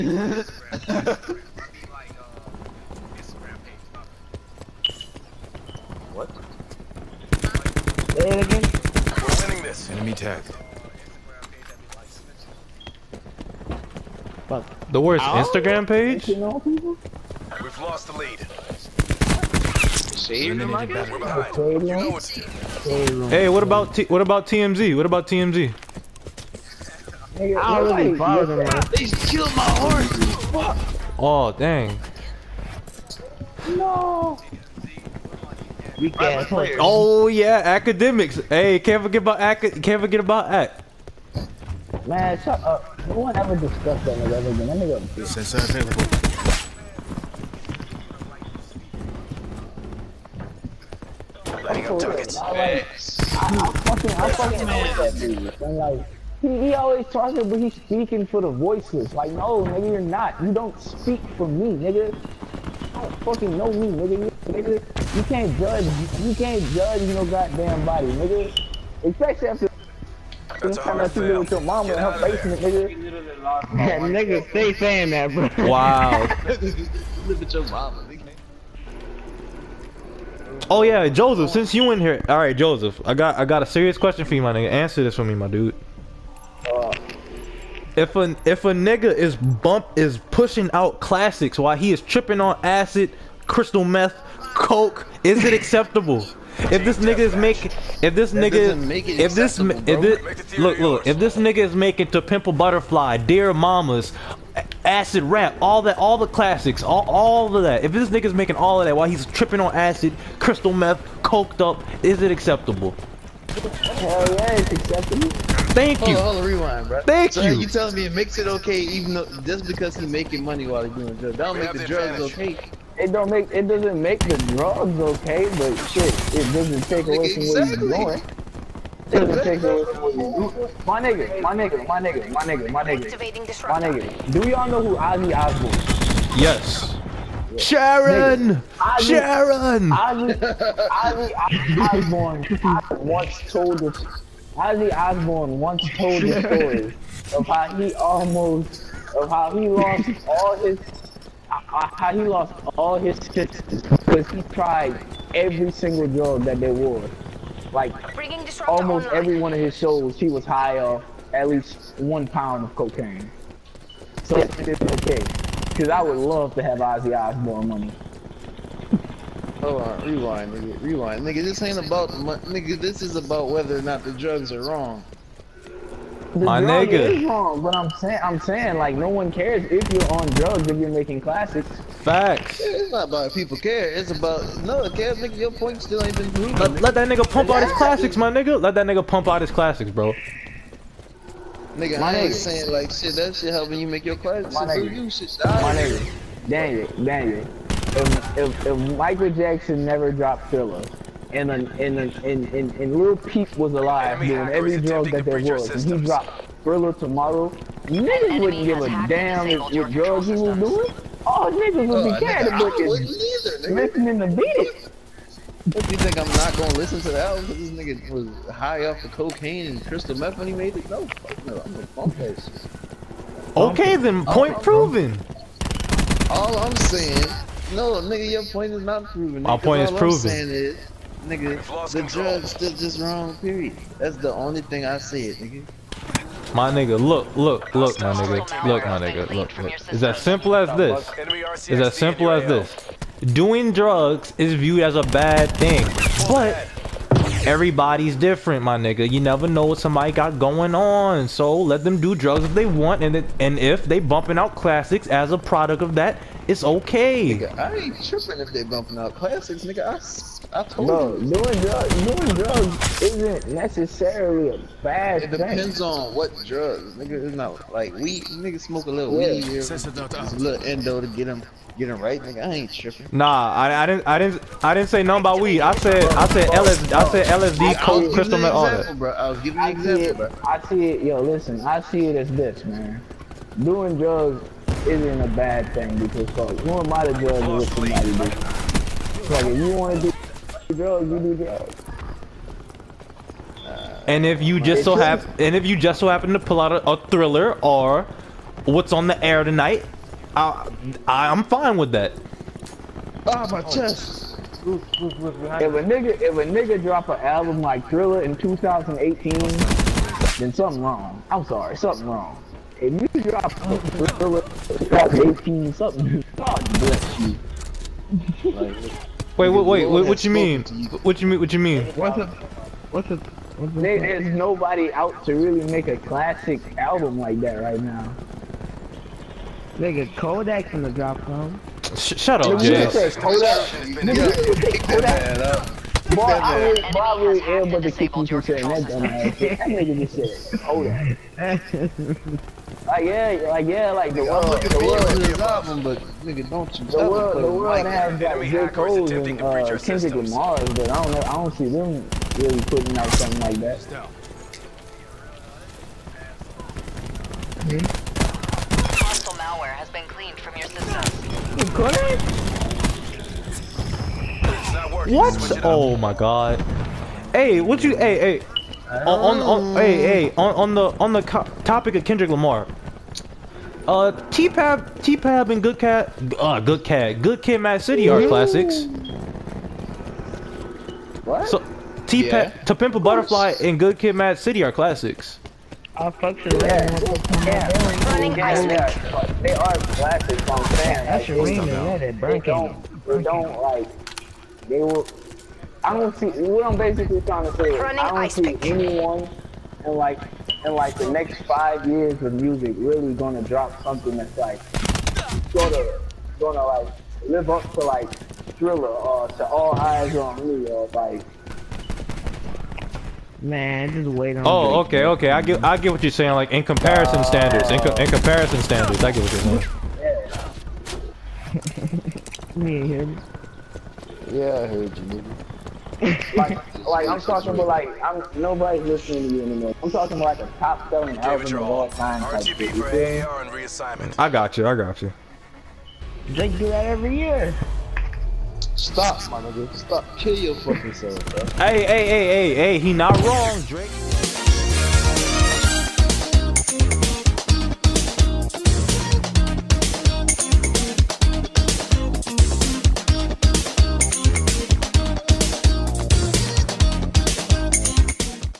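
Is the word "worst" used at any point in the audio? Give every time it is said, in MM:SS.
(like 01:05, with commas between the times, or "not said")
00:15.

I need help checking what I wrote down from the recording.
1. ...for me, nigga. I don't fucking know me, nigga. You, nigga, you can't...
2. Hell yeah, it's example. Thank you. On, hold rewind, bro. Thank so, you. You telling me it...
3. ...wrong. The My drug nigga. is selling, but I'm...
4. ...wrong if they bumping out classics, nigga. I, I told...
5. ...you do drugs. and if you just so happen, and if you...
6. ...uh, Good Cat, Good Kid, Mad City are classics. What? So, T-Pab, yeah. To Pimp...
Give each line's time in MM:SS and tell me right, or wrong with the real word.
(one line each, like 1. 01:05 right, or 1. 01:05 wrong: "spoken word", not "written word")
1. 01:01 right
2. 01:53 wrong: "acceptable", not "example"
3. 02:54 wrong: "wrong", not "selling"
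4. 04:18 wrong: "tripping", not "wrong"
5. 04:51 right
6. 06:16 right.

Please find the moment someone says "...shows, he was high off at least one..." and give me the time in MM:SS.
02:39.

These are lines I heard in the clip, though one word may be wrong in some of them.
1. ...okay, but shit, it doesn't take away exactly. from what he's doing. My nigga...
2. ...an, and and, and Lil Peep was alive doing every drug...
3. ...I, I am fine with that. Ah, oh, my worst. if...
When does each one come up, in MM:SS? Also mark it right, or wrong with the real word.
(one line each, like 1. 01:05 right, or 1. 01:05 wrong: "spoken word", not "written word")
1. 02:04 right
2. 03:21 right
3. 05:00 wrong: "chest", not "worst".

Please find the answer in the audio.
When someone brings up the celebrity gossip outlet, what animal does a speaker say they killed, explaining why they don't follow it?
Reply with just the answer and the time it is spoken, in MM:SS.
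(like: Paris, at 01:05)
horse, at 00:29.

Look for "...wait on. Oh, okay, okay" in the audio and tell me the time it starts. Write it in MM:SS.
06:54.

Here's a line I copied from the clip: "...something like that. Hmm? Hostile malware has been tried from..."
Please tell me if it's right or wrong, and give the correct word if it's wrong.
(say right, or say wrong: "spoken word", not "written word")
wrong: "cleaned", not "tried".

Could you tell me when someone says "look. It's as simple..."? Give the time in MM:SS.
03:59.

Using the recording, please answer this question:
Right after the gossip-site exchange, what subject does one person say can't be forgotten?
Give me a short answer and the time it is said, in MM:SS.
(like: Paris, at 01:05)
academics, at 00:37.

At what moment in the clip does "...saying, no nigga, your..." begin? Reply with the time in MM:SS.
03:46.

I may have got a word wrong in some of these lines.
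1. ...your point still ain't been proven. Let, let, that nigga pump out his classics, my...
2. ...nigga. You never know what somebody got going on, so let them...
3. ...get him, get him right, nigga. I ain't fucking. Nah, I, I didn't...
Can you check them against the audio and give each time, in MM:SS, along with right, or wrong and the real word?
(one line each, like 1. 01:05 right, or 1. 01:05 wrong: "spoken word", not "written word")
1. 03:05 right
2. 04:08 right
3. 04:31 wrong: "tripping", not "fucking".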